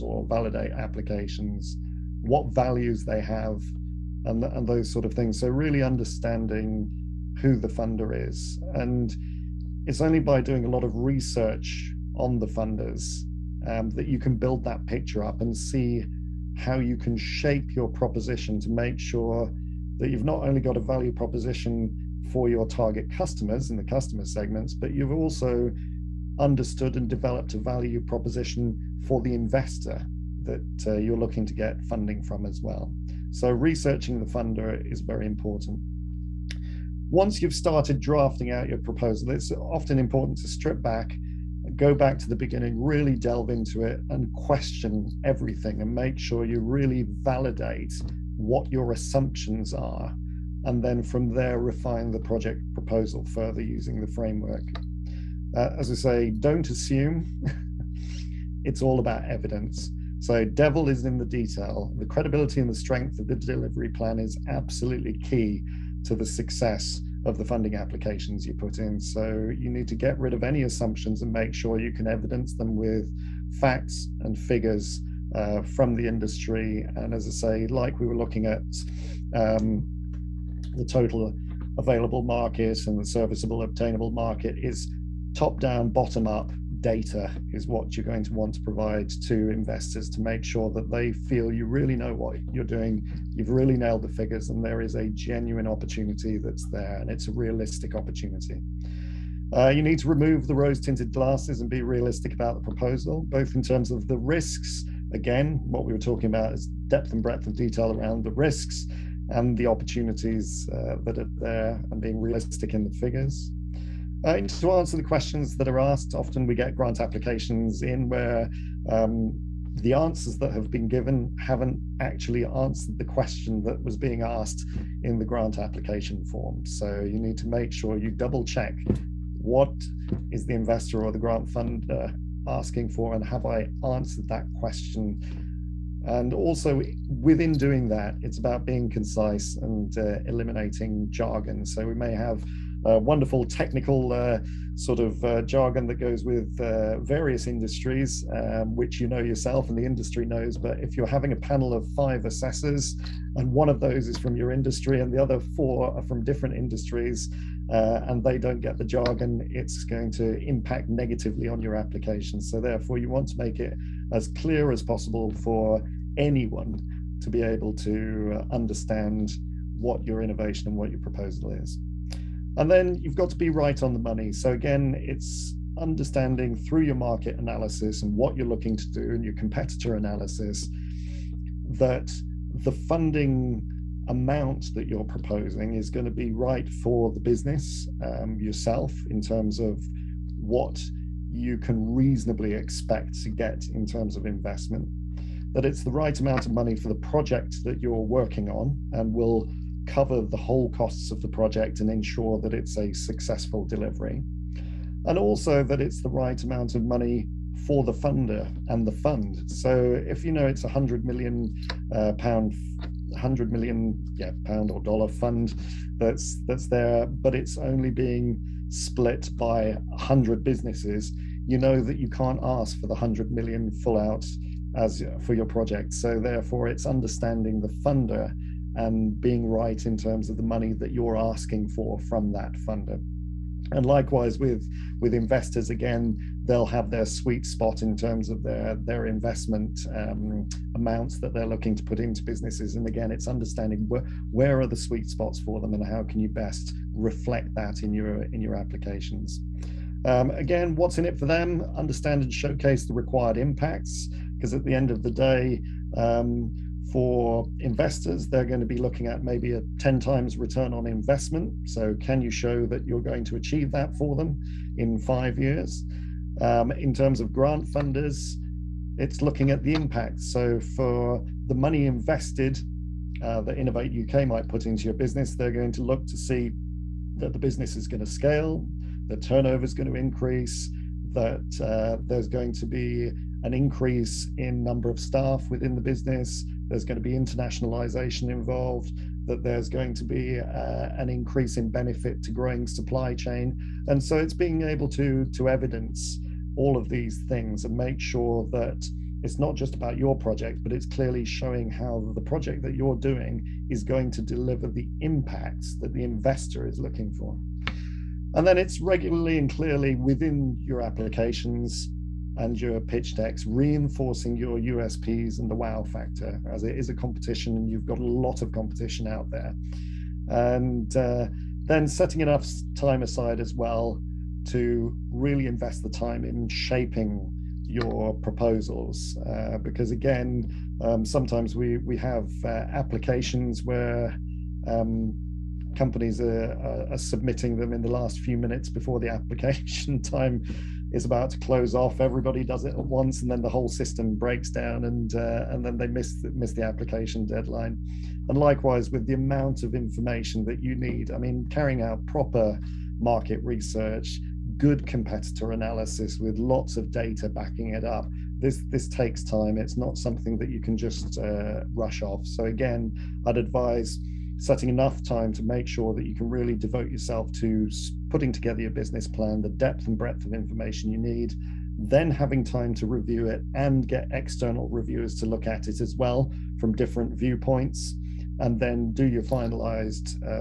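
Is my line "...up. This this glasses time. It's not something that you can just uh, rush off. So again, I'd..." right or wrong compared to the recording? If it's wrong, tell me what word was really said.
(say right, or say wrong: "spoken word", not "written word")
wrong: "takes", not "glasses".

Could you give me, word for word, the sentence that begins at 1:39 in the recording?
Uh, you need to remove the rose tinted glasses and be realistic about the proposal, both in terms of the risks.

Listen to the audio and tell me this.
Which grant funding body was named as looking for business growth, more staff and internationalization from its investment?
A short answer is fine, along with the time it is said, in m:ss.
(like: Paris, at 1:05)
Innovate UK, at 4:33.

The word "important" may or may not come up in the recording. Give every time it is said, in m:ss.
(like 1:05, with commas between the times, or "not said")
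0:35, 0:39.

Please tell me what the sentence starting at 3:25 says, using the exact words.
And also that it's the right amount of money for the funder and the fund.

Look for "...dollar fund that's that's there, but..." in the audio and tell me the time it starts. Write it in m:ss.
3:34.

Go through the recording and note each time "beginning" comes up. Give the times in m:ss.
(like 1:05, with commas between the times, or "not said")
0:42.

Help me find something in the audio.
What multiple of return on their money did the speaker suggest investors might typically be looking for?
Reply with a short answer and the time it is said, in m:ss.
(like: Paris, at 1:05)
10 times, at 4:19.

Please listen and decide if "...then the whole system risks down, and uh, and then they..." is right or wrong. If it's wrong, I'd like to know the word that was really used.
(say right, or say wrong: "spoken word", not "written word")
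wrong: "breaks", not "risks".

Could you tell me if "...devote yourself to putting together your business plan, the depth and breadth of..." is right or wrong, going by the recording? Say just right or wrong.
right.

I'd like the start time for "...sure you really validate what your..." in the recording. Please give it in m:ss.
0:46.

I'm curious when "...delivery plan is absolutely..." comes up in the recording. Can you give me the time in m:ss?
1:03.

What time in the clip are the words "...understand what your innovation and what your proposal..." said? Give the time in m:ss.
2:48.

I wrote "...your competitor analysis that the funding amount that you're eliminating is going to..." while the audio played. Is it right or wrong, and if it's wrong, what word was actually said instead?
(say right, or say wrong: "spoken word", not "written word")
wrong: "proposing", not "eliminating".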